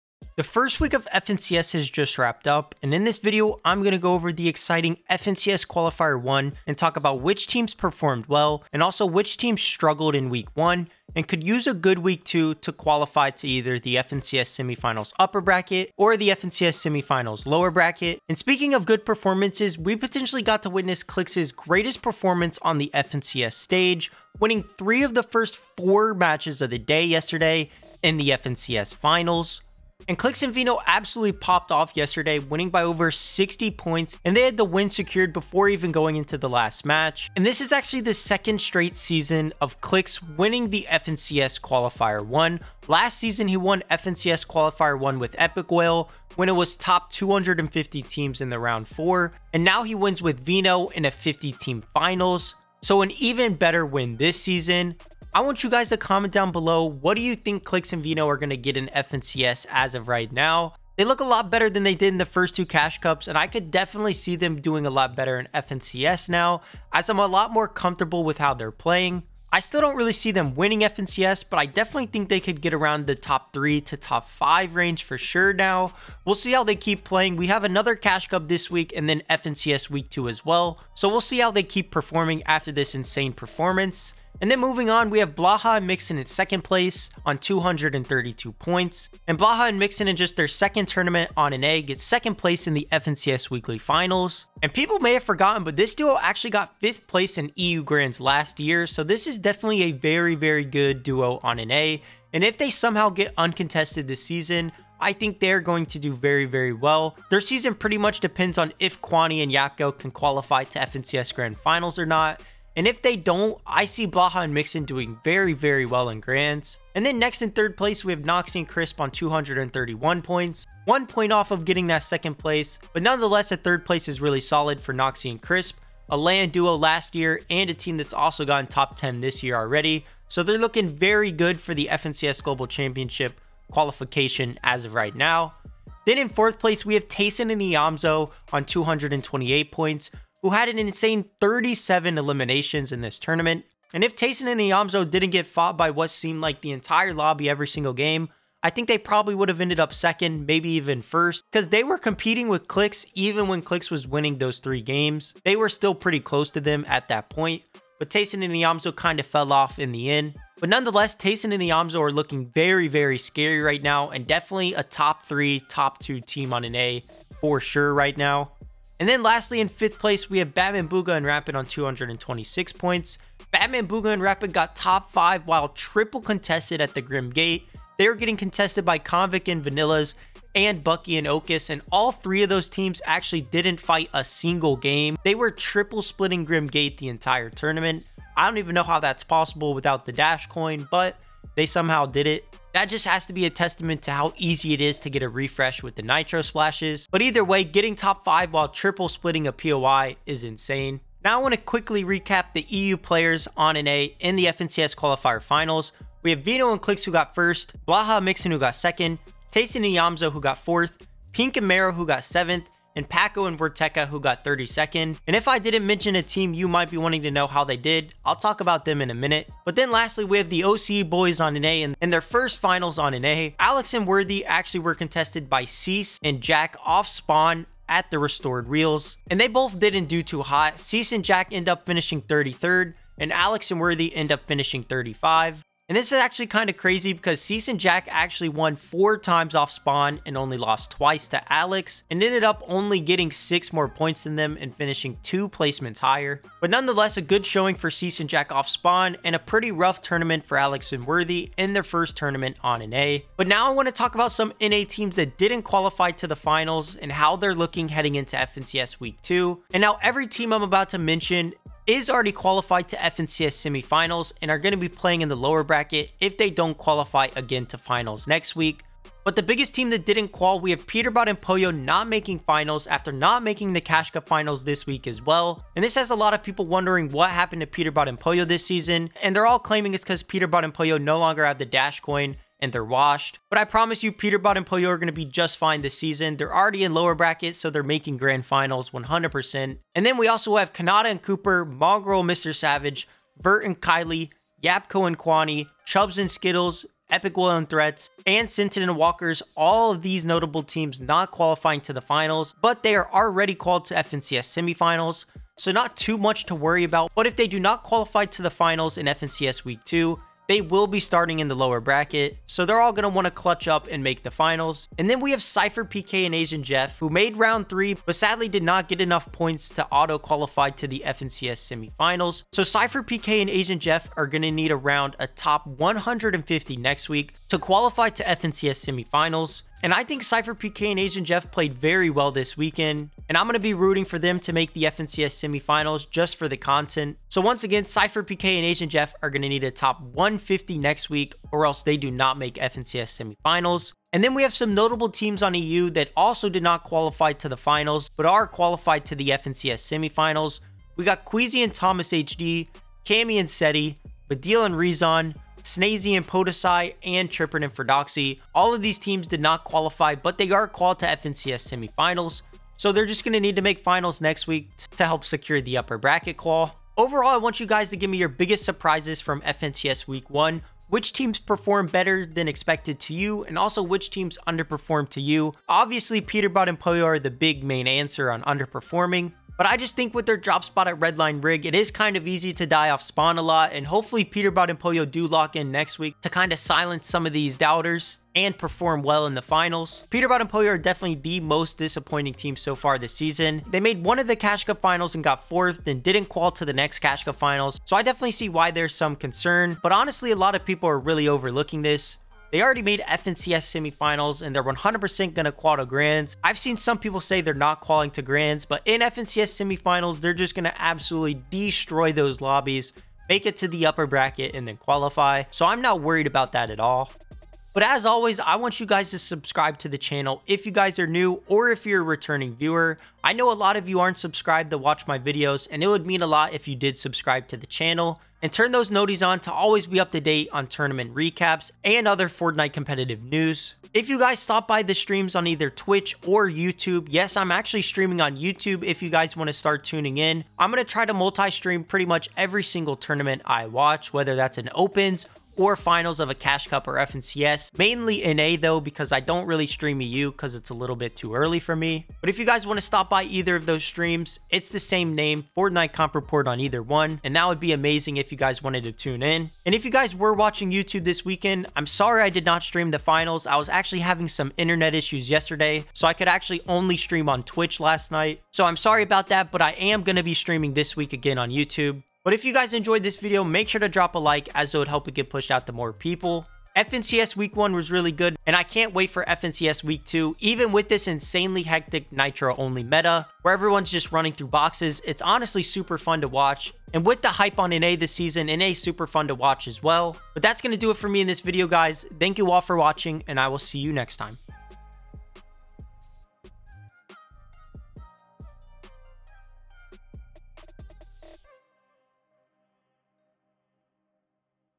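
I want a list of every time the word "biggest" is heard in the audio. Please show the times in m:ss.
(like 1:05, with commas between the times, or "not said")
4:29, 6:08.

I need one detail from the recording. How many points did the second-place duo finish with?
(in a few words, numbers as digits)
232.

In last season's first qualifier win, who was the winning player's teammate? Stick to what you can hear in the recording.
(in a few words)
Epikwhale.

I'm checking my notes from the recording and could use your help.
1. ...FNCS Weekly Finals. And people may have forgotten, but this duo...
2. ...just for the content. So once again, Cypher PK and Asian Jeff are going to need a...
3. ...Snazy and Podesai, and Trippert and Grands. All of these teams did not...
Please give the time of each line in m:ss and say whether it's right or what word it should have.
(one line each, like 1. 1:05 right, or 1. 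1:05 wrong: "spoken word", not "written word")
1. 1:32 right
2. 5:36 right
3. 5:55 wrong: "Ferdoxy", not "Grands".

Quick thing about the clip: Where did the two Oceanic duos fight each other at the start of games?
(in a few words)
Restored Reels.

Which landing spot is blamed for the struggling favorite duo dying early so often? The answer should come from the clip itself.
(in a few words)
Redline Rig.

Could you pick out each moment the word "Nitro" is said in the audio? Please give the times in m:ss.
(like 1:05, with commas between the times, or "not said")
3:16, 8:02.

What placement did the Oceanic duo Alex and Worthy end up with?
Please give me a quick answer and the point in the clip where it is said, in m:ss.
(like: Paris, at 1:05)
35th, at 3:54.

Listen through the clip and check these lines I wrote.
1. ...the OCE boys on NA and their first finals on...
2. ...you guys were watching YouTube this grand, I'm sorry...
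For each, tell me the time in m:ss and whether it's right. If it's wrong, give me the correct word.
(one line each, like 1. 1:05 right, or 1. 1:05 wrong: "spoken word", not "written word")
1. 3:40 right
2. 7:39 wrong: "weekend", not "grand".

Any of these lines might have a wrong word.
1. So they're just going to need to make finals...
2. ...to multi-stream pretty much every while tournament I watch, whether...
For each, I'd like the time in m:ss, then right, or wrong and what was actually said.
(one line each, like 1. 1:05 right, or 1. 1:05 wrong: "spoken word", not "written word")
1. 6:02 right
2. 7:21 wrong: "single", not "while".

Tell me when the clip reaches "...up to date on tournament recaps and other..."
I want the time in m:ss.
7:09.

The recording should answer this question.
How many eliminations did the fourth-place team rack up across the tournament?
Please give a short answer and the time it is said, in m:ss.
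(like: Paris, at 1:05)
37, at 2:21.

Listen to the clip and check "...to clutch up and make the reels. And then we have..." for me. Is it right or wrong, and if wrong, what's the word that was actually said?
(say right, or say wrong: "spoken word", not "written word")
wrong: "finals", not "reels".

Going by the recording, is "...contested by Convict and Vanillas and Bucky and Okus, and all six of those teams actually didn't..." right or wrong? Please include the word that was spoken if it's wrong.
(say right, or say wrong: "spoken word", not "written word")
wrong: "three", not "six".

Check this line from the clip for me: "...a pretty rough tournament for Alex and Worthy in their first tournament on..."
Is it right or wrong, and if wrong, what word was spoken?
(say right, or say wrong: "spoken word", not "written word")
right.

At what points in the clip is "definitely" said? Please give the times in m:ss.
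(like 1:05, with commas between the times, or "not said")
1:03, 1:11, 1:39, 2:44, 6:30, 6:38.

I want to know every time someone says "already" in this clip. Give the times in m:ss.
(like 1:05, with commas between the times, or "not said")
2:09, 4:22, 4:46, 5:03, 6:42.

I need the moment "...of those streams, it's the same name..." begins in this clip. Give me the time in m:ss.
7:33.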